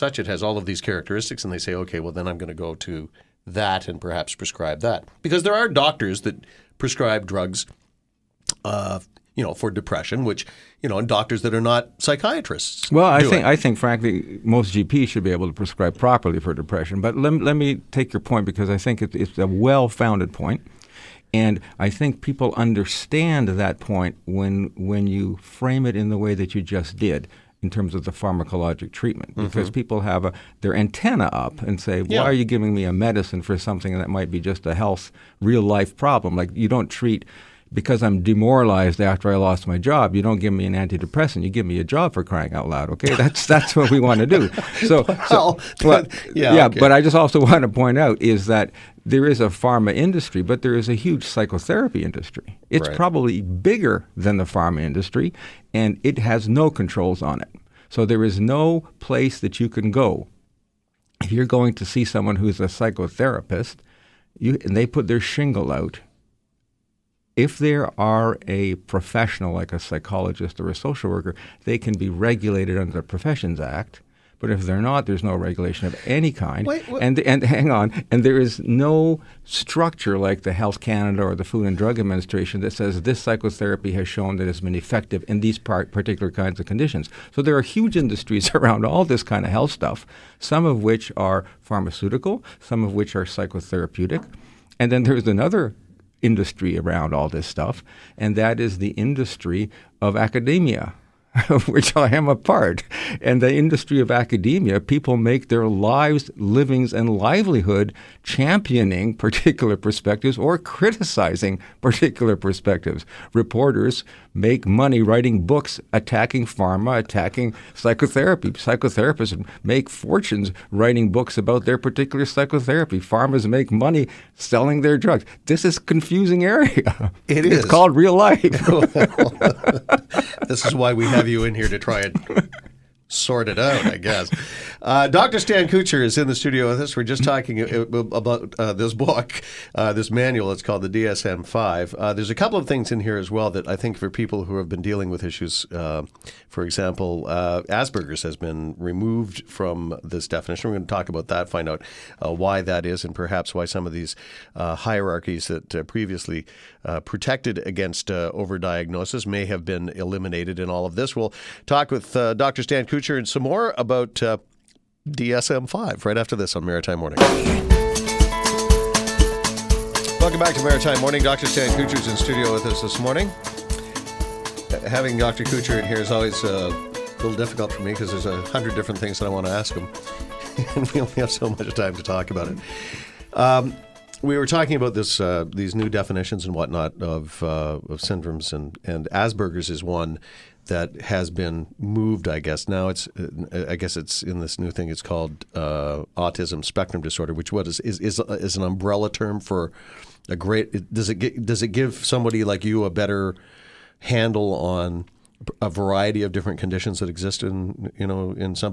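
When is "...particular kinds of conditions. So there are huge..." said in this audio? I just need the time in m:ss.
1:25.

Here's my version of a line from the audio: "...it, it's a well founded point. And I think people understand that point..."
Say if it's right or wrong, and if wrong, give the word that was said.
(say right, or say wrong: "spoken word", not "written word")
right.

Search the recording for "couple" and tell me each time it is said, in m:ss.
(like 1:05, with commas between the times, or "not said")
2:22.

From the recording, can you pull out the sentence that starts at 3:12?
I guess now it's I guess it's in this new thing.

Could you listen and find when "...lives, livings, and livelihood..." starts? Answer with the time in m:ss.
1:45.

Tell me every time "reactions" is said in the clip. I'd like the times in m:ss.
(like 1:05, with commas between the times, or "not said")
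not said.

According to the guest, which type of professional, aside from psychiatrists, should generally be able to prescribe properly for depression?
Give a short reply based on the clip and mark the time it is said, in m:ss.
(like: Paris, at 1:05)
GPs, at 0:14.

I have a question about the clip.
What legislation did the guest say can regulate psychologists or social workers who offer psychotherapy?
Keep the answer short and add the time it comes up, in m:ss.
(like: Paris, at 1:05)
Professions Act, at 1:13.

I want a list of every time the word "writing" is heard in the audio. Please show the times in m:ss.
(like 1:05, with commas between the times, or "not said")
1:55, 2:00.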